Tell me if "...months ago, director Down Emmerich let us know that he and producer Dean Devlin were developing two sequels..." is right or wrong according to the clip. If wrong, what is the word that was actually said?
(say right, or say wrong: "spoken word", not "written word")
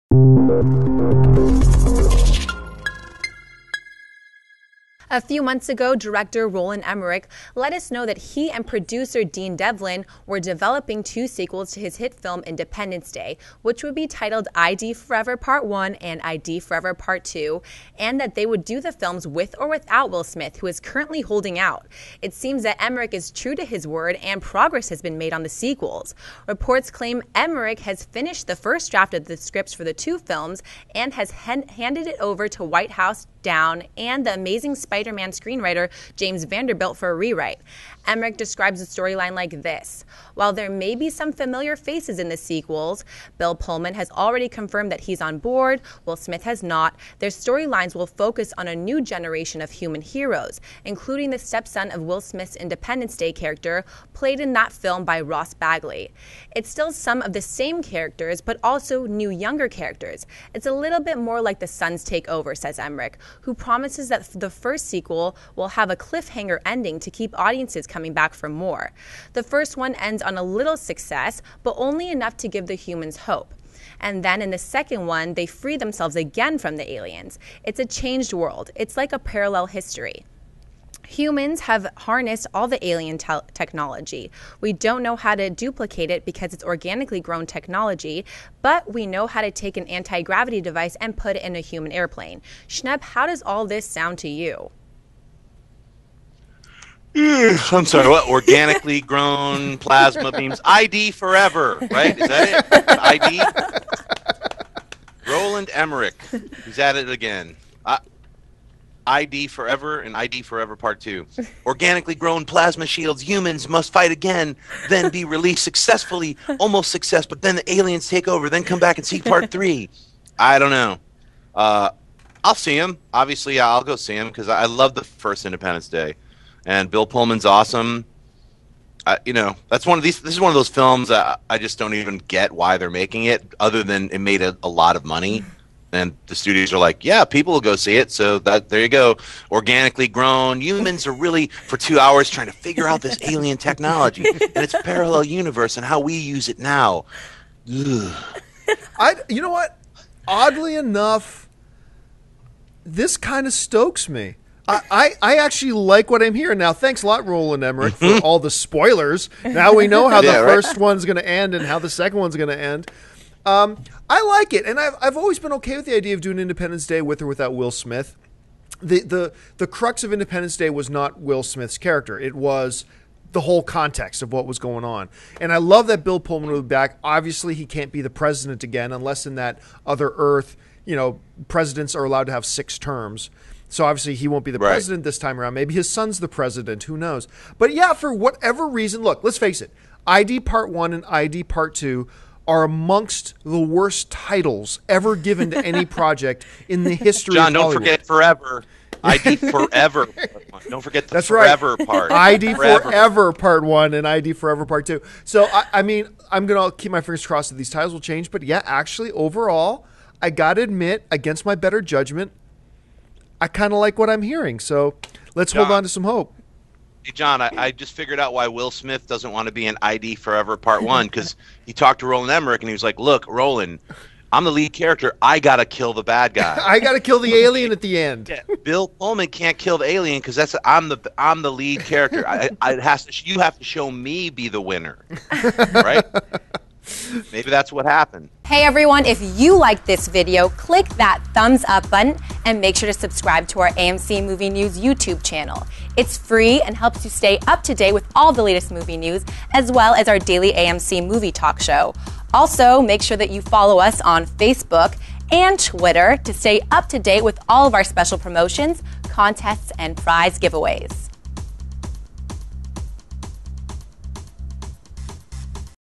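wrong: "Roland", not "Down".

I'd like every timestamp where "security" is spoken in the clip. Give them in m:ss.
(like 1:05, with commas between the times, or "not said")
not said.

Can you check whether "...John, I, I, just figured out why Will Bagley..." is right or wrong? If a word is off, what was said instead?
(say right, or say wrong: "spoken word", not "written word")
wrong: "Smith", not "Bagley".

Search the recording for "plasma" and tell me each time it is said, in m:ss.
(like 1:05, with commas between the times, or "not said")
1:39, 1:52.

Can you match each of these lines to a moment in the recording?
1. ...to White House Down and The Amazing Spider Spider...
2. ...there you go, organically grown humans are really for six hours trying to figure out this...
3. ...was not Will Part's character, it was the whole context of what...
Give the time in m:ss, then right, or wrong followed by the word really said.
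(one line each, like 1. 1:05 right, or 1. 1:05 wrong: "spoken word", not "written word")
1. 0:32 right
2. 2:18 wrong: "two", not "six"
3. 2:50 wrong: "Smith", not "Part".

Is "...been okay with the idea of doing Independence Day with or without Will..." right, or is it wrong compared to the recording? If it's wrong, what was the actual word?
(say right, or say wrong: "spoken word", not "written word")
right.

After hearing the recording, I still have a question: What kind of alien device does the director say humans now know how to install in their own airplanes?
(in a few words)
anti gravity device.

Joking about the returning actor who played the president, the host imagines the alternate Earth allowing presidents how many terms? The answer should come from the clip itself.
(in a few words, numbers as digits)
6.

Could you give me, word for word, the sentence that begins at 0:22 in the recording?
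It seems that Emmerich is true to his word and progress has been made on the sequels.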